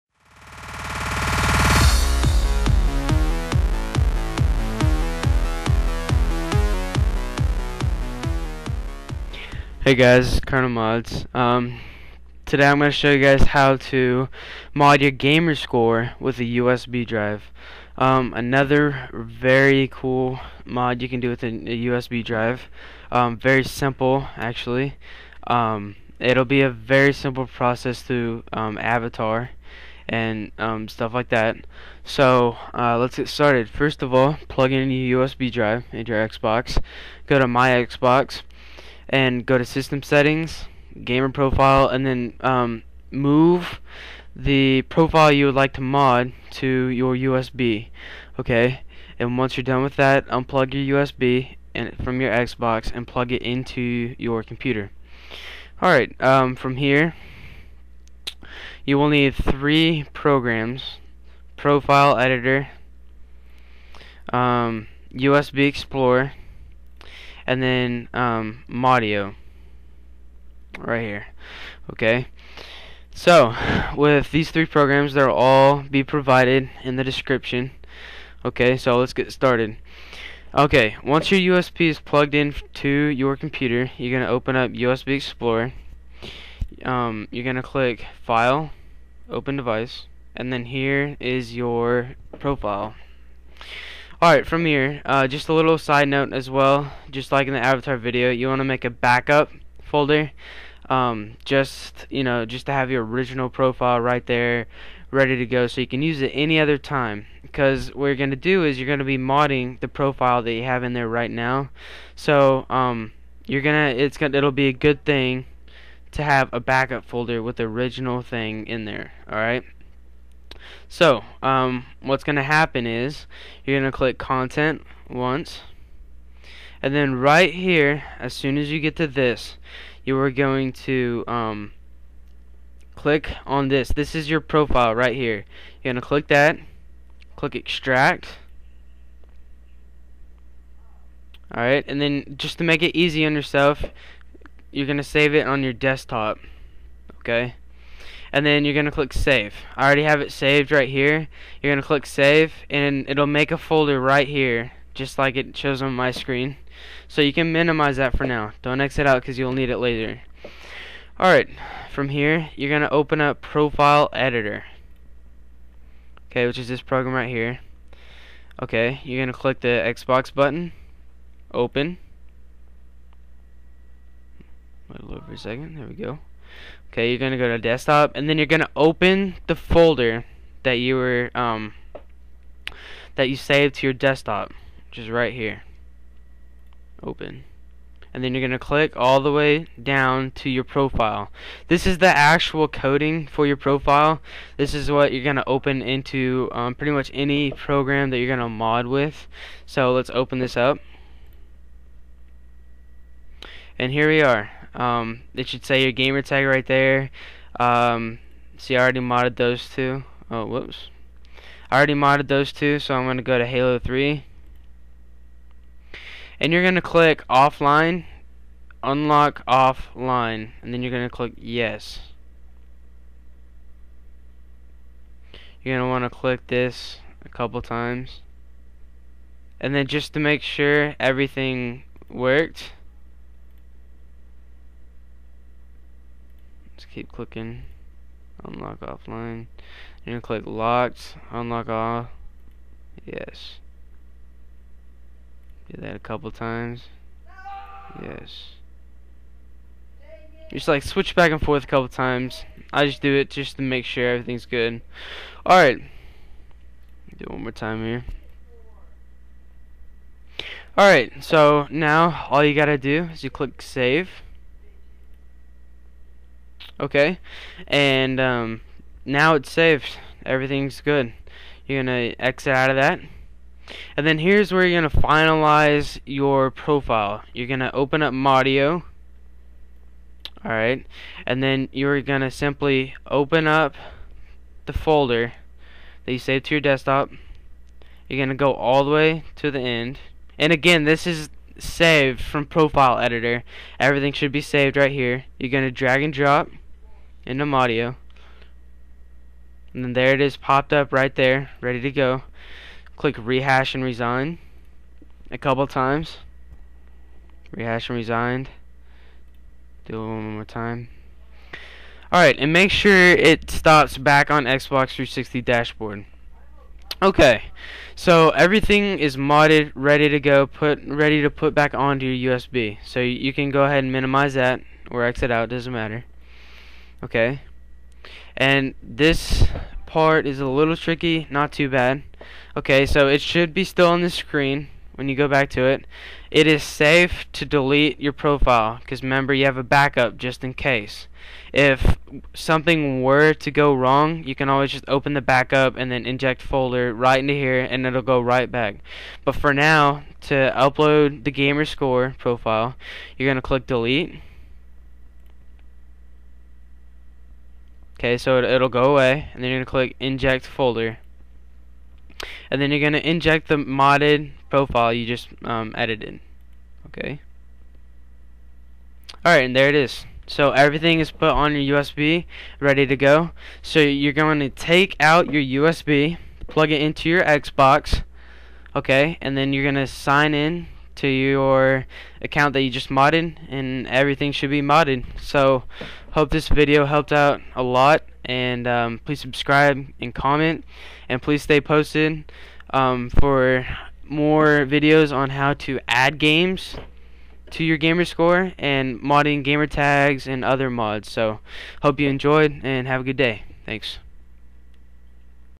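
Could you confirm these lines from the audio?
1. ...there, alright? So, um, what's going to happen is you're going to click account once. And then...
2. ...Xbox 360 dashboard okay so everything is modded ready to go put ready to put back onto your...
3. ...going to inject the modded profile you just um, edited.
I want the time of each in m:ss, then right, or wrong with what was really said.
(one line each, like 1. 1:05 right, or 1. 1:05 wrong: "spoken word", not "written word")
1. 1:58 wrong: "content", not "account"
2. 5:14 right
3. 6:02 right.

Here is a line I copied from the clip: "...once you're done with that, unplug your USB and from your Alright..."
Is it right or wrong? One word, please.
wrong.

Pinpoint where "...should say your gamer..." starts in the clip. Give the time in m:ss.
3:25.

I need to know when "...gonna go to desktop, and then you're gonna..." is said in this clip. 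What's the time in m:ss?
2:57.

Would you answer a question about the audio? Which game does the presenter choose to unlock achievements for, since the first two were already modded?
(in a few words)
Halo 3.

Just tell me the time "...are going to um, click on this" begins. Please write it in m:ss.
2:10.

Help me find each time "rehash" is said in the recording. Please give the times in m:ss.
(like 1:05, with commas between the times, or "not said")
5:03, 5:07.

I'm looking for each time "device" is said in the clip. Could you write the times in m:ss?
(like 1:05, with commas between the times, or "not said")
1:29.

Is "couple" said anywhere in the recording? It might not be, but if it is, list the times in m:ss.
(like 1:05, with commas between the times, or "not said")
3:47, 4:05, 4:11, 5:05.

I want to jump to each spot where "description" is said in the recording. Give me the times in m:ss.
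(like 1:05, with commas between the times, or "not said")
1:17.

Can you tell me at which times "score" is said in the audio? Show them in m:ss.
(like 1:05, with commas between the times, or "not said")
0:15, 5:51, 6:38.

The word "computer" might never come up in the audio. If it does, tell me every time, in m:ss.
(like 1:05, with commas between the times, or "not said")
0:54, 1:23.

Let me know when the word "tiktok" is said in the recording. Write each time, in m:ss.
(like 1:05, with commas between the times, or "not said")
not said.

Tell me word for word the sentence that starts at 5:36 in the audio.
It is safe to delete your profile because remember you have a backup just in case.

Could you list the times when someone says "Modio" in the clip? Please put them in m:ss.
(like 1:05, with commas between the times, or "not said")
1:08, 4:38, 4:57.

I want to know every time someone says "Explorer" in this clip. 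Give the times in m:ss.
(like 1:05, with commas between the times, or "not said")
1:05, 1:25.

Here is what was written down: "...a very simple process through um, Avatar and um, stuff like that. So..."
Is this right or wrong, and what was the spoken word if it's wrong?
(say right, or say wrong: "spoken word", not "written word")
right.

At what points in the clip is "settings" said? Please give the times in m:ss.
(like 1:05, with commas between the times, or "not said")
0:40.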